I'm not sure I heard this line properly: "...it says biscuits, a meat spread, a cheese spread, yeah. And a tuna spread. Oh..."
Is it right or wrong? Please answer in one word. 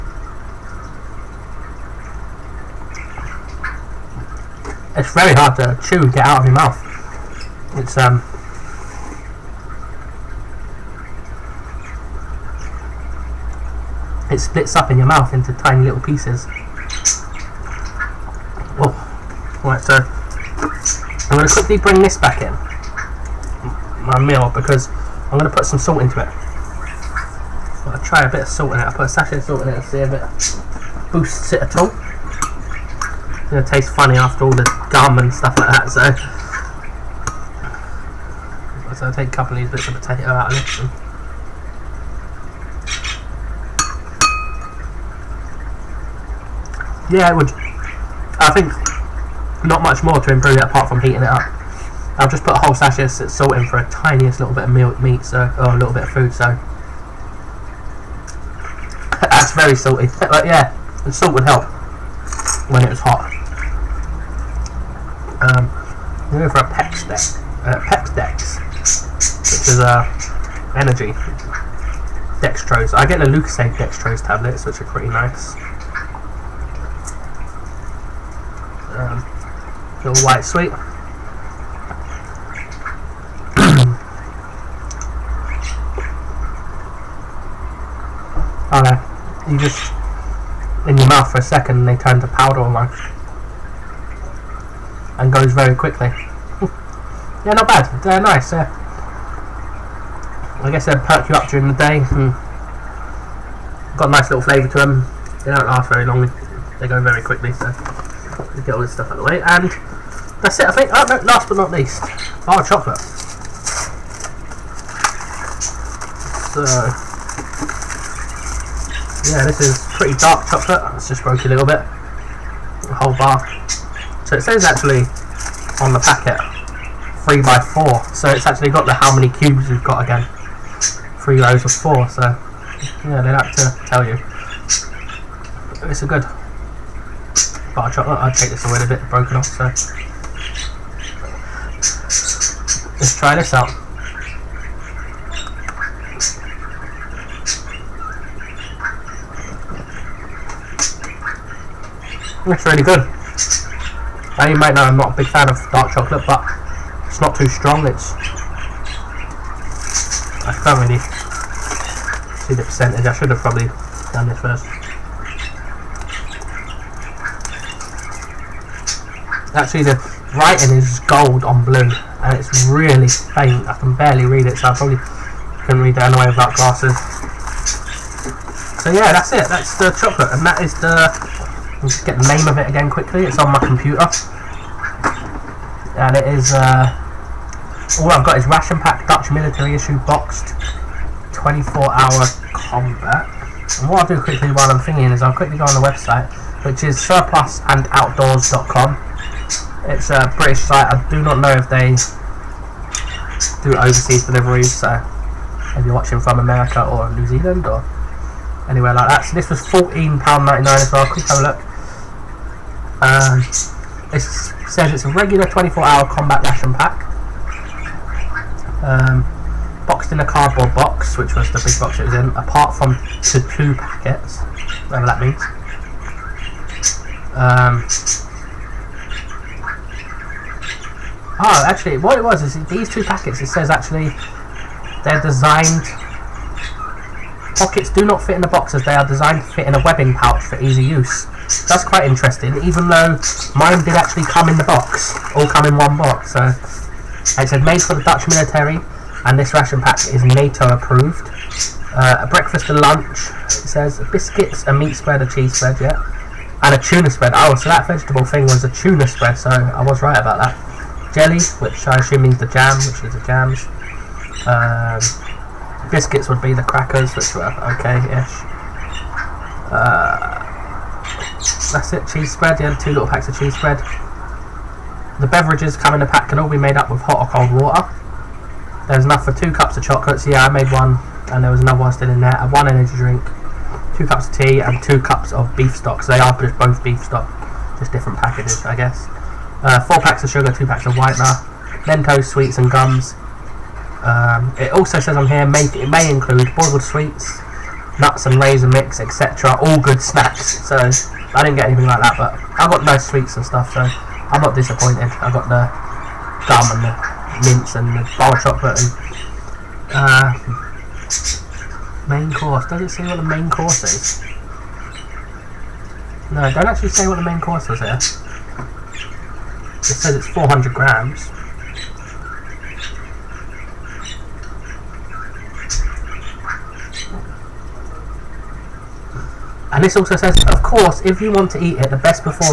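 right.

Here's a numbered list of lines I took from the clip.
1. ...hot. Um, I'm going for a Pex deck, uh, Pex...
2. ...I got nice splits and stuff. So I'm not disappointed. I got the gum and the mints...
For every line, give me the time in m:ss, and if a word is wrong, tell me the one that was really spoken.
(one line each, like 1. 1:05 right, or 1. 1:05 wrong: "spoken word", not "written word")
1. 1:02 right
2. 5:02 wrong: "sweets", not "splits".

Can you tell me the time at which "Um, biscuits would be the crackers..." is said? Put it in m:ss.
4:24.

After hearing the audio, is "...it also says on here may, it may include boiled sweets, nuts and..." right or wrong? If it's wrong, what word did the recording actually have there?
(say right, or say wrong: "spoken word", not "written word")
right.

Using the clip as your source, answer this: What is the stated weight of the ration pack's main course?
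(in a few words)
400 grams.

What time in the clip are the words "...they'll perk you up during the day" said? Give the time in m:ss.
1:40.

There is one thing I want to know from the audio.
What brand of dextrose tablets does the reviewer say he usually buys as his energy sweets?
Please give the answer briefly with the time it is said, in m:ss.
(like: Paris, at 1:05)
Lucozade, at 1:13.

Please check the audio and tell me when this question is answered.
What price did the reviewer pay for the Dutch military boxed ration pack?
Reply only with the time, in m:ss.
3:29.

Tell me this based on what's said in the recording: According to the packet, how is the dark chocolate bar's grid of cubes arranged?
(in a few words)
3 by 4.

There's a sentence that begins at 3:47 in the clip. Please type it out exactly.
Um, Oh, actually, what it was is these two packets, it says actually they're designed...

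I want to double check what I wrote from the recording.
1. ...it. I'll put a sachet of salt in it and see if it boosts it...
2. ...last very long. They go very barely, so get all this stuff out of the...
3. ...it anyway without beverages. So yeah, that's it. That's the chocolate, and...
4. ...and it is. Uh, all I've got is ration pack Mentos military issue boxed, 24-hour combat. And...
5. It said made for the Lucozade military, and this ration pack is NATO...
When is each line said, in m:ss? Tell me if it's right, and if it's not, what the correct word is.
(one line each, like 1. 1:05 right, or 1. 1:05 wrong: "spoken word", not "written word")
1. 0:28 right
2. 1:45 wrong: "quickly", not "barely"
3. 2:55 wrong: "glasses", not "beverages"
4. 3:05 wrong: "Dutch", not "Mentos"
5. 4:07 wrong: "Dutch", not "Lucozade".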